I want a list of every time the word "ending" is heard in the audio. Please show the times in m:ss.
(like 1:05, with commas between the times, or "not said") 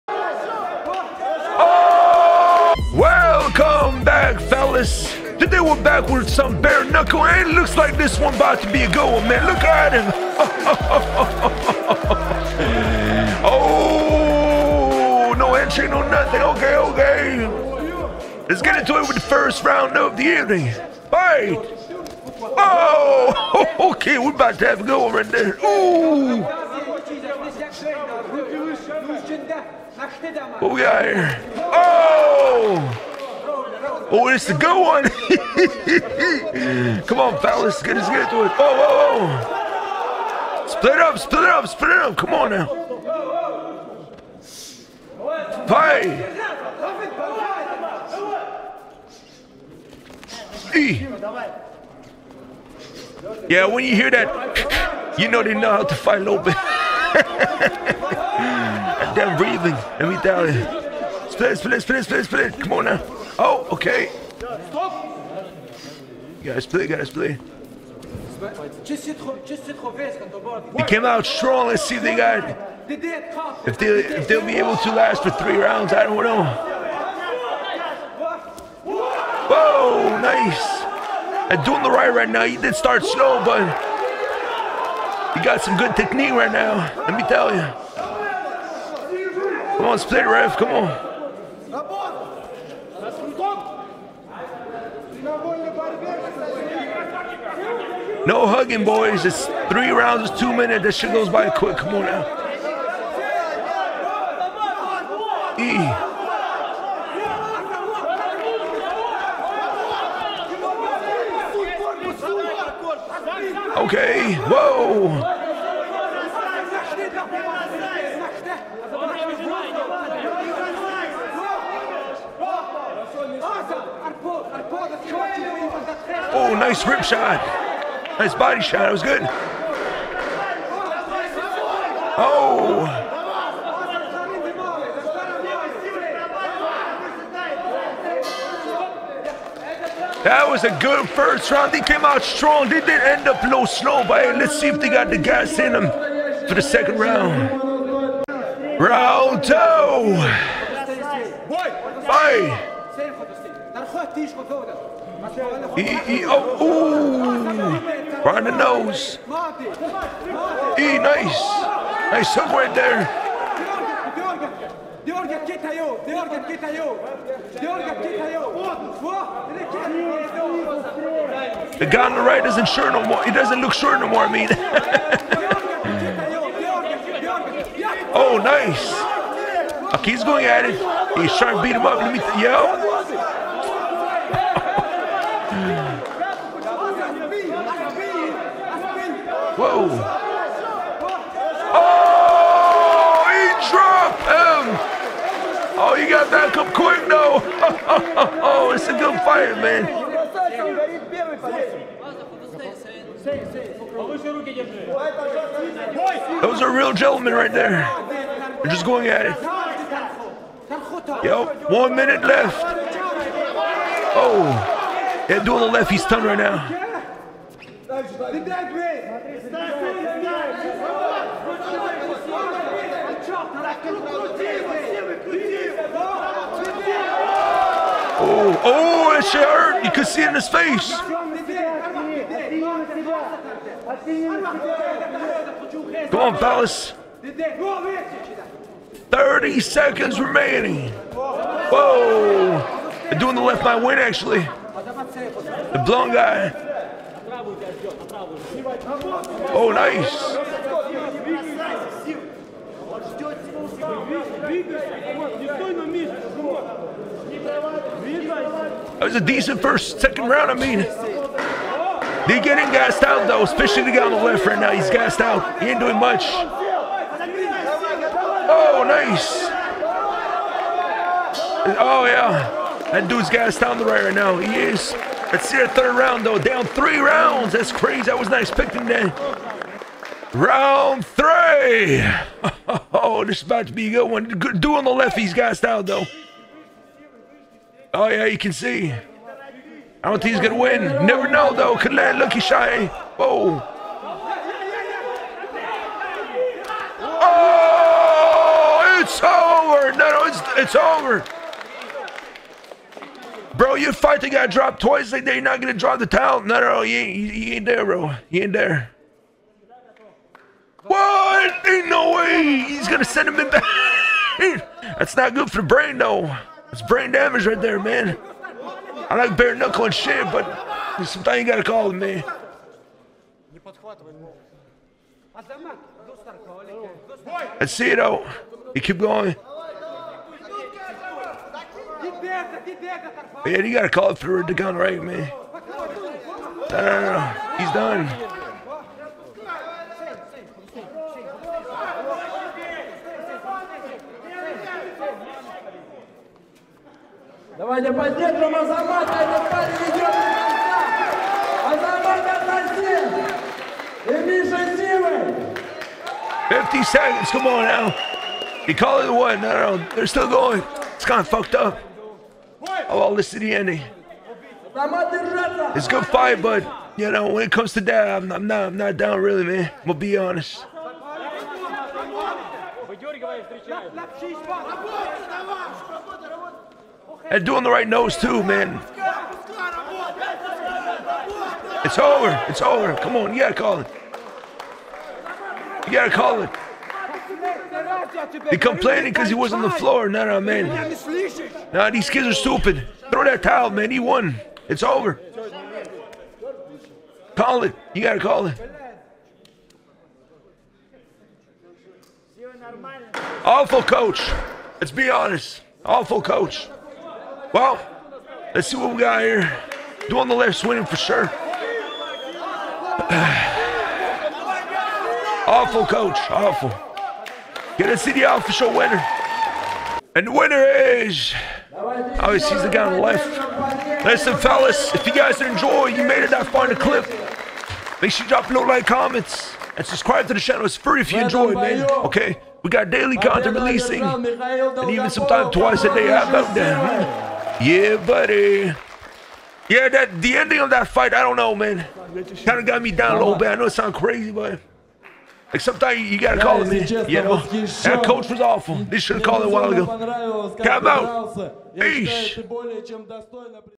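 6:03, 7:20.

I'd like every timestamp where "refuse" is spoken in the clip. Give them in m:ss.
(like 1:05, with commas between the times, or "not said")
not said.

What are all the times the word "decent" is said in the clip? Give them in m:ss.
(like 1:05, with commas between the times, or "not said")
4:19.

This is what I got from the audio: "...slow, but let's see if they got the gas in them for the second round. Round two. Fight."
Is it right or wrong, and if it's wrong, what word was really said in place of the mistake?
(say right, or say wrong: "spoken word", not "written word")
right.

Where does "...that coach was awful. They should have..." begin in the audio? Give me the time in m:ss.
7:27.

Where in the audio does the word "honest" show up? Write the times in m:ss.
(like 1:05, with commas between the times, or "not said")
6:10, 6:45.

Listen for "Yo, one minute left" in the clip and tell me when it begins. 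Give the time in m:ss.
3:31.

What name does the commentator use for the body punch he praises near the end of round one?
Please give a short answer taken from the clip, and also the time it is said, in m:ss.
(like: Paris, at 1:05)
Rip shot, at 2:06.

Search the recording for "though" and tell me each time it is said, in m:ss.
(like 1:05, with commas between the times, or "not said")
3:17, 4:23, 4:36, 4:45, 4:51, 5:15, 5:27.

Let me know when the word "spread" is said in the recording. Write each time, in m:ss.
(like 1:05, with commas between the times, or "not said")
not said.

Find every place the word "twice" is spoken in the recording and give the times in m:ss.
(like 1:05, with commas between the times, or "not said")
5:04, 7:15.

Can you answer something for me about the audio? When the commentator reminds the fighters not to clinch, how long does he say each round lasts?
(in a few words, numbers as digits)
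2 minutes.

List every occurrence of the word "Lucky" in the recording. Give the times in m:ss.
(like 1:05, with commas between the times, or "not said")
4:52.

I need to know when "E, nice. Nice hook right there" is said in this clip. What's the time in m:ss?
2:39.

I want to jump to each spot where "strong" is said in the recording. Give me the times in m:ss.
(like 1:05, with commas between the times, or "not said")
1:11, 2:22.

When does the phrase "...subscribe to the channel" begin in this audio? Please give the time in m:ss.
7:09.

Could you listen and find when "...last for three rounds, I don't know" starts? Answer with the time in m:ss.
1:14.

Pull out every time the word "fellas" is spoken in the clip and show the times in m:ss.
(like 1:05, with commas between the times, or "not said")
0:37, 3:56, 7:04.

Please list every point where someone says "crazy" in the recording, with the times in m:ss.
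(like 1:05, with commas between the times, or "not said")
4:37, 7:23.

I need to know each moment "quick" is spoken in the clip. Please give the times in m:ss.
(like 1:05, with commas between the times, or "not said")
1:41, 3:16.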